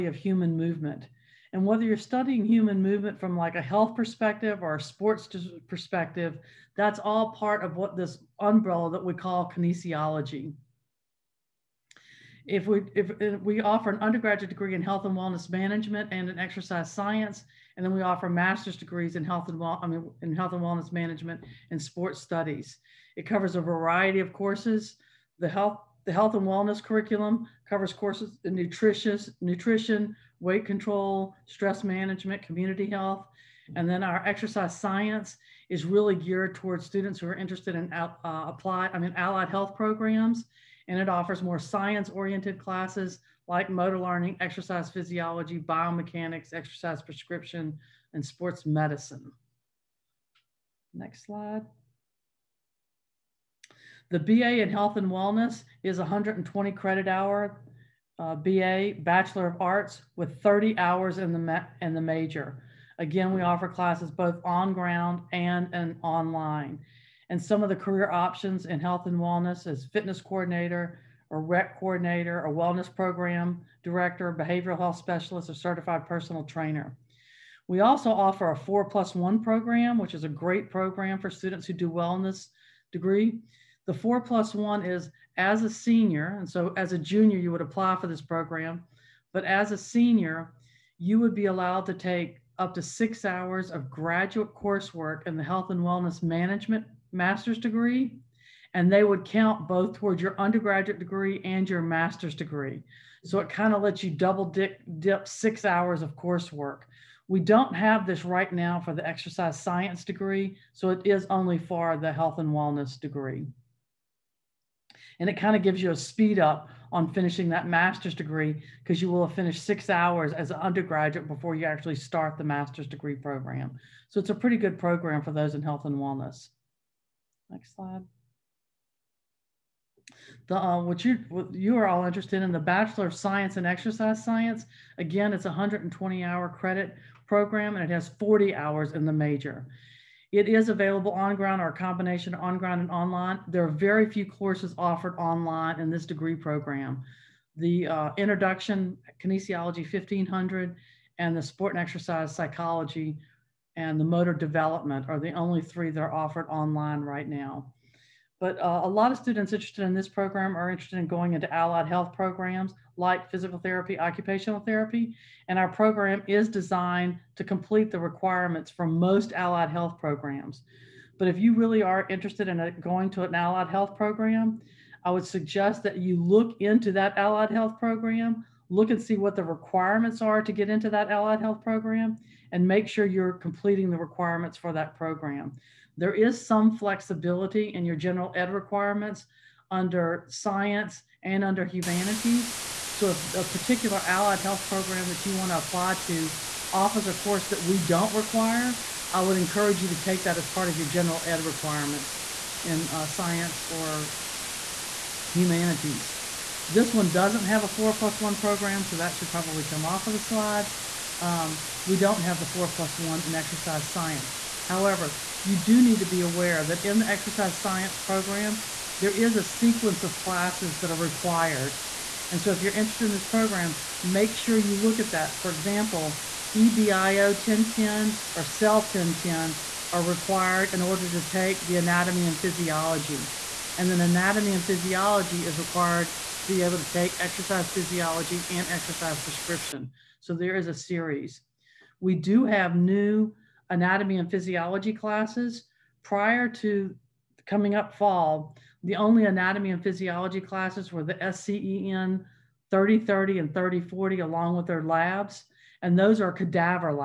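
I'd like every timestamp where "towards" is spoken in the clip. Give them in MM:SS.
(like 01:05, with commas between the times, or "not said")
00:36, 01:39.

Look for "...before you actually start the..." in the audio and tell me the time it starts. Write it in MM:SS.
02:01.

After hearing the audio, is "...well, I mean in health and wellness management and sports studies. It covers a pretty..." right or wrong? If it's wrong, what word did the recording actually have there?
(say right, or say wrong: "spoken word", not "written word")
wrong: "variety", not "pretty".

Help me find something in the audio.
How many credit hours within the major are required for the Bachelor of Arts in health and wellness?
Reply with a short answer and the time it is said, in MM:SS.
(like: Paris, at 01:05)
30, at 01:00.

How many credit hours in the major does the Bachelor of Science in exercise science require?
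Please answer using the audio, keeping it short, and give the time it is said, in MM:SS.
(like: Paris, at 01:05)
40, at 02:18.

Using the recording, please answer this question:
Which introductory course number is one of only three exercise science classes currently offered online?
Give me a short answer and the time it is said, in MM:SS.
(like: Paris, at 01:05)
Kinesiology 1500, at 02:29.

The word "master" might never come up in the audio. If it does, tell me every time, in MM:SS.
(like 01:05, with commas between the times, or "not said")
00:18, 01:37, 01:41, 01:57, 02:02.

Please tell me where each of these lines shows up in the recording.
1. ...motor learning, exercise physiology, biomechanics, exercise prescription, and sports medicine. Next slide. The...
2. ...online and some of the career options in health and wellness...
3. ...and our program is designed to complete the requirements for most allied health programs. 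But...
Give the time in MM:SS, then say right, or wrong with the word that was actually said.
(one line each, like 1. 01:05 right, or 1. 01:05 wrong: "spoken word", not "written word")
1. 00:43 right
2. 01:06 right
3. 02:45 right.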